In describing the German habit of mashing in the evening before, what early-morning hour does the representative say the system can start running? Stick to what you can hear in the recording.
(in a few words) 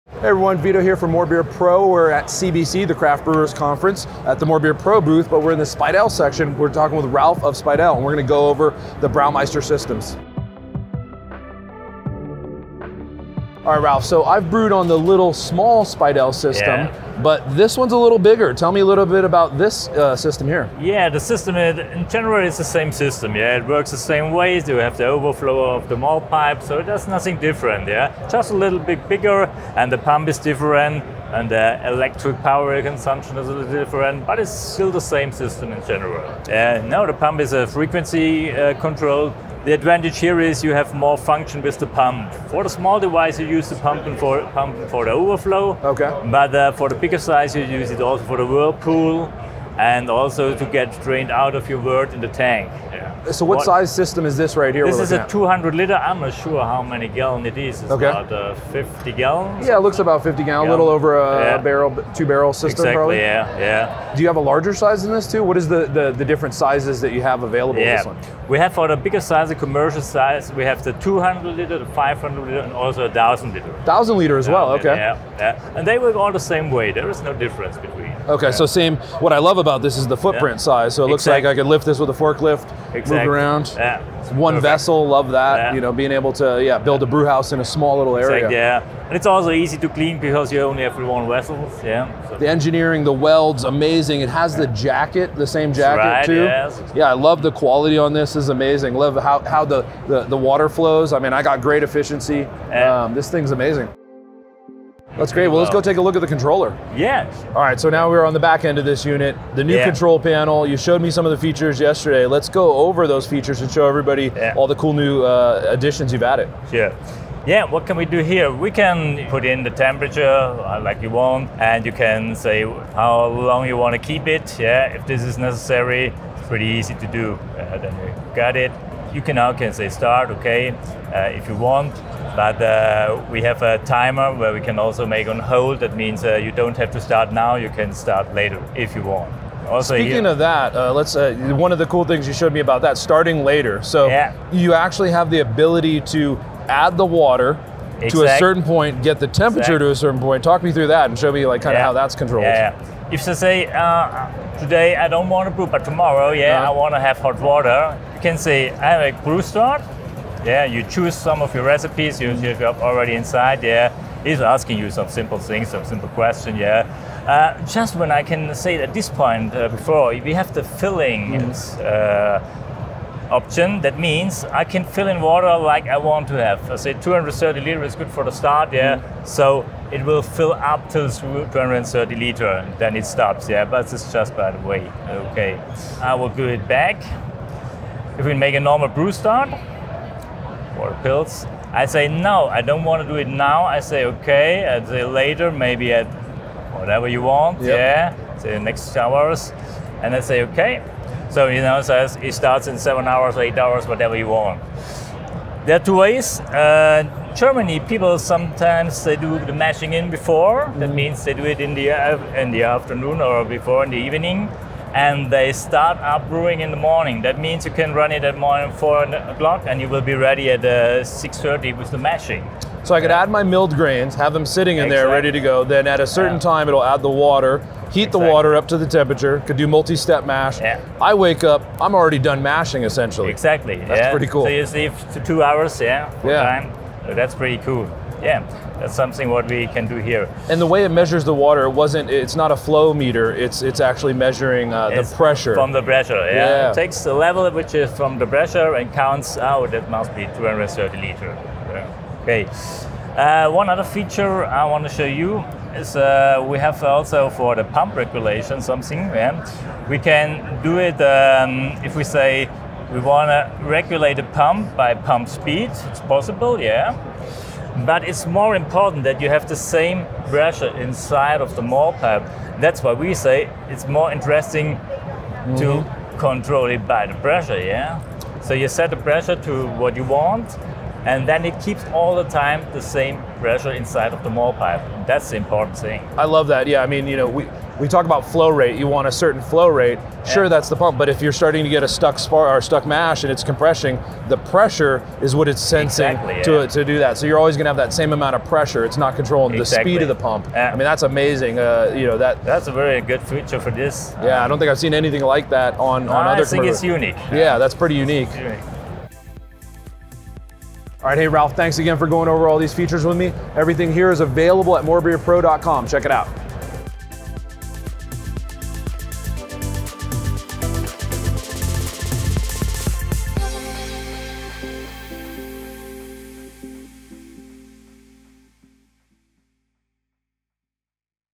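4 o'clock.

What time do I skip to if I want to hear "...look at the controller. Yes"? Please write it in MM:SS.
01:46.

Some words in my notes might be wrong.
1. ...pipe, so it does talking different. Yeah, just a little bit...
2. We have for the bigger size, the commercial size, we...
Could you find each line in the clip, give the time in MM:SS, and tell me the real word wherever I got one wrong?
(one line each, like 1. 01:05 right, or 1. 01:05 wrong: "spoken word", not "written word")
1. 00:26 wrong: "nothing", not "talking"
2. 01:08 right.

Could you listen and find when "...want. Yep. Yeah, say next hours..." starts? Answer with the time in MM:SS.
03:17.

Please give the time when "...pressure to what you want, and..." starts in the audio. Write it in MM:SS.
04:38.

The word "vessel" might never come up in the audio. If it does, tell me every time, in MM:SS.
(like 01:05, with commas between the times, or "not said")
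01:24, 01:31.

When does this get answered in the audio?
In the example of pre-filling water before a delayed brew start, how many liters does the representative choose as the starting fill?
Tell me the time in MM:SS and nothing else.
02:56.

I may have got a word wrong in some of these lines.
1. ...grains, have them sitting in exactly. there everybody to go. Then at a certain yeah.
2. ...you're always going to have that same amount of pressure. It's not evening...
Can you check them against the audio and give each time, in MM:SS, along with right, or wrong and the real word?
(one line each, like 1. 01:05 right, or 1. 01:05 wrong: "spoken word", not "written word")
1. 03:43 wrong: "ready", not "everybody"
2. 04:57 wrong: "controlling", not "evening".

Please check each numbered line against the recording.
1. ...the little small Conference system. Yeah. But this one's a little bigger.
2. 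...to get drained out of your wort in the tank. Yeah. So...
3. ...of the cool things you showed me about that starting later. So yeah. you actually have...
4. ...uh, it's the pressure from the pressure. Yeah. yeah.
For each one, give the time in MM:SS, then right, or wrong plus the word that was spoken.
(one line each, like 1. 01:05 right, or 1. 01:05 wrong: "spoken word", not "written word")
1. 00:14 wrong: "Speidel", not "Conference"
2. 00:50 right
3. 02:21 right
4. 04:04 right.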